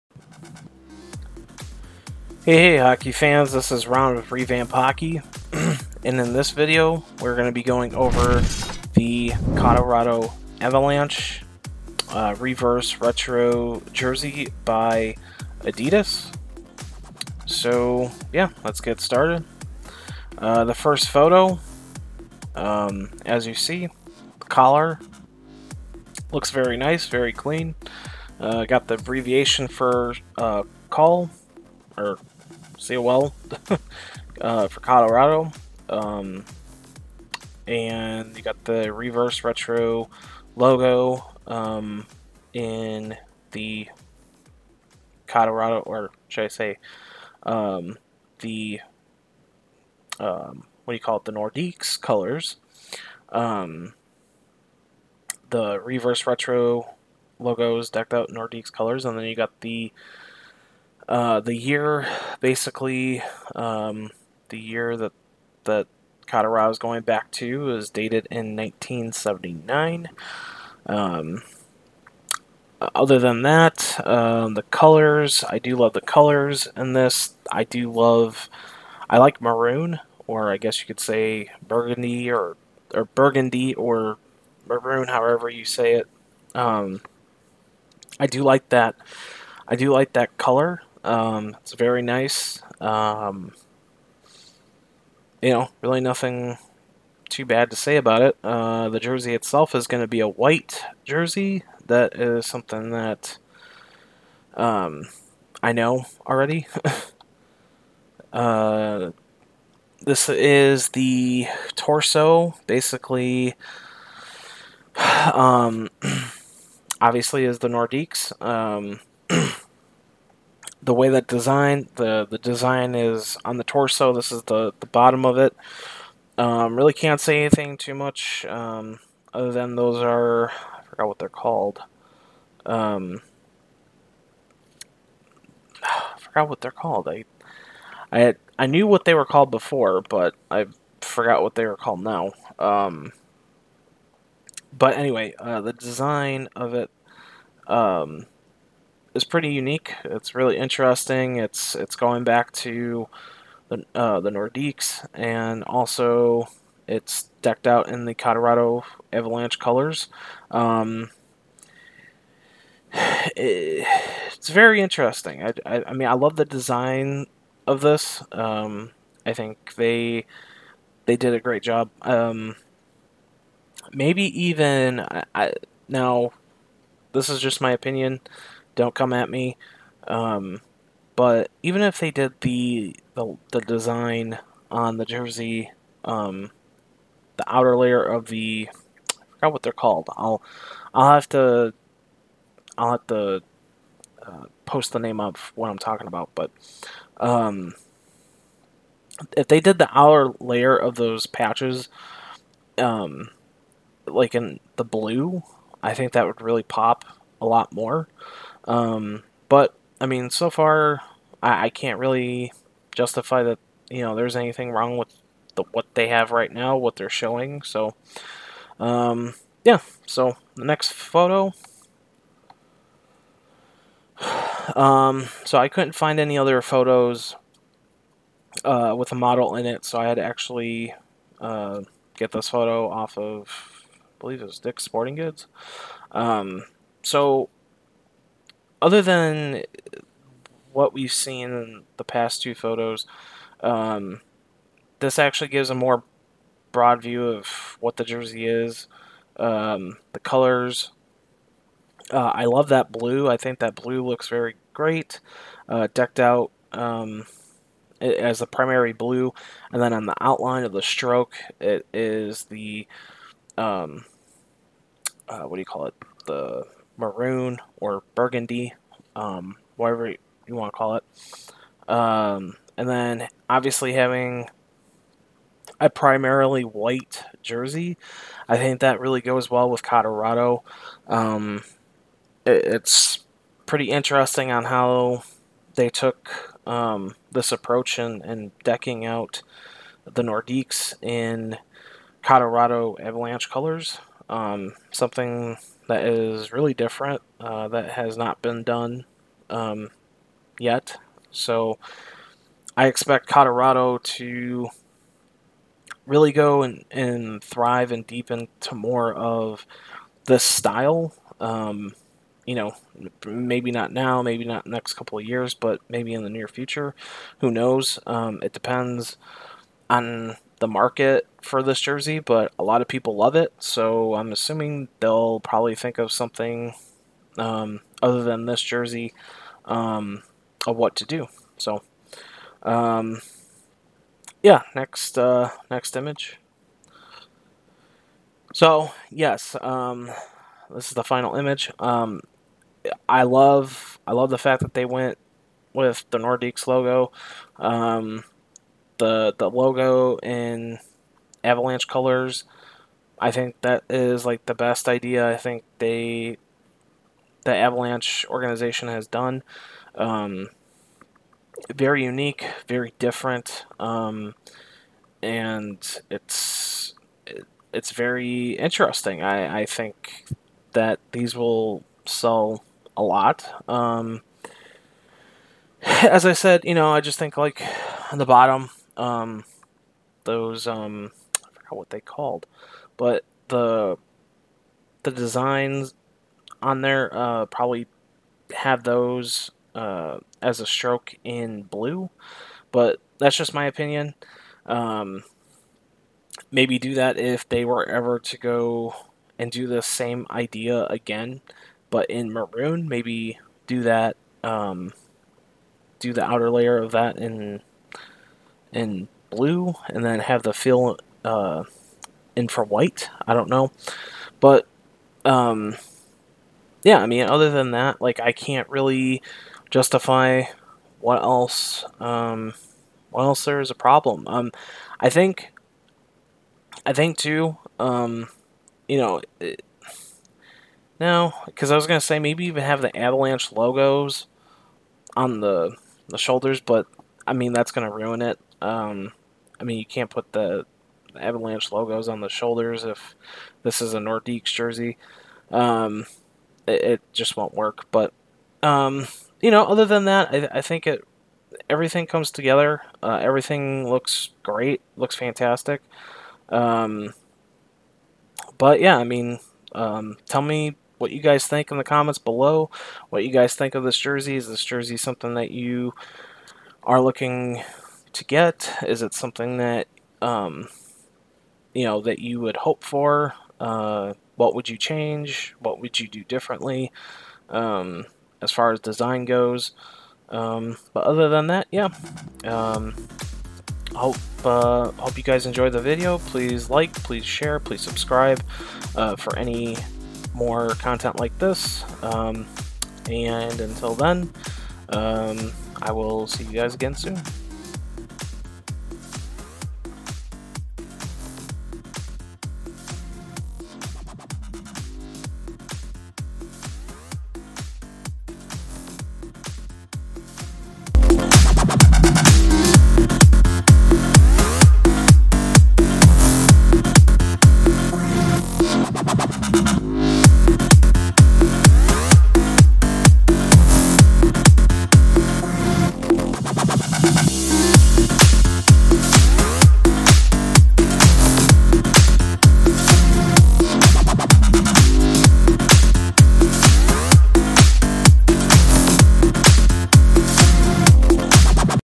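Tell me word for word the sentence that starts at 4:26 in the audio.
The maroon or burgundy, um, whatever you want to call it.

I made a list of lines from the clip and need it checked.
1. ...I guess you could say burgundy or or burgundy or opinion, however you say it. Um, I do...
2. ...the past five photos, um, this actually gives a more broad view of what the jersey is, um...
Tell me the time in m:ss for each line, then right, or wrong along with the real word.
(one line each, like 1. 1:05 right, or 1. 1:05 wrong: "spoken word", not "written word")
1. 1:20 wrong: "maroon", not "opinion"
2. 4:01 wrong: "two", not "five".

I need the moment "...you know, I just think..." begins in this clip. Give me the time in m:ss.
6:16.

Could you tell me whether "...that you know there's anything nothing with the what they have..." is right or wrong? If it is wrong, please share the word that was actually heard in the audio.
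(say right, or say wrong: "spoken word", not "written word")
wrong: "wrong", not "nothing".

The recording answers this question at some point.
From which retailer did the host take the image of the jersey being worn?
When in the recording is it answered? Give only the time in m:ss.
3:54.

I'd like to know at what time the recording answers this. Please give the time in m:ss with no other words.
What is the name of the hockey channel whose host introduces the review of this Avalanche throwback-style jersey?
0:04.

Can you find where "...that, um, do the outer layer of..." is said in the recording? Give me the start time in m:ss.
6:43.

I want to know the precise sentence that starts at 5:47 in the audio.
Um, the the logo in Avalanche colors.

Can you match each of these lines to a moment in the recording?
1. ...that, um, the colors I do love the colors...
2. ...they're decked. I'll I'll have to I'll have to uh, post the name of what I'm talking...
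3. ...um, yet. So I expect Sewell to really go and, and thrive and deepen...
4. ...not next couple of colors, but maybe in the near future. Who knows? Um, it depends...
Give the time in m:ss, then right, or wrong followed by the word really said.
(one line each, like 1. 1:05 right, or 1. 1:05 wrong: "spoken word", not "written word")
1. 1:13 right
2. 3:09 wrong: "called", not "decked"
3. 4:59 wrong: "Colorado", not "Sewell"
4. 5:14 wrong: "years", not "colors".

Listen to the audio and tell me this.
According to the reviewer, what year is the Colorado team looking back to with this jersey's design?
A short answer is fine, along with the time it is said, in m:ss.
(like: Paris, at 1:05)
1979, at 1:08.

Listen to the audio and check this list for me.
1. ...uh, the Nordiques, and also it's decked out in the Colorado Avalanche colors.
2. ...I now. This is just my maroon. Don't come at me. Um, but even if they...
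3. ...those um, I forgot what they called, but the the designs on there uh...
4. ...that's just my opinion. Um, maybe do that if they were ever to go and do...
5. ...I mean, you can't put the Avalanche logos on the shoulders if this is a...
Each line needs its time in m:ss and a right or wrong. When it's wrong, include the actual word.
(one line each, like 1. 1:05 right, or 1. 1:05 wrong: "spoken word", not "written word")
1. 2:33 right
2. 2:55 wrong: "opinion", not "maroon"
3. 6:20 right
4. 6:33 right
5. 7:19 right.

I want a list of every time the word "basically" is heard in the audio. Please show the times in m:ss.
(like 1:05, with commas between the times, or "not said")
1:02, 1:52.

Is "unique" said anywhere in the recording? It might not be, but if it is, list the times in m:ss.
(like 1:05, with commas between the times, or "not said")
2:29, 6:02.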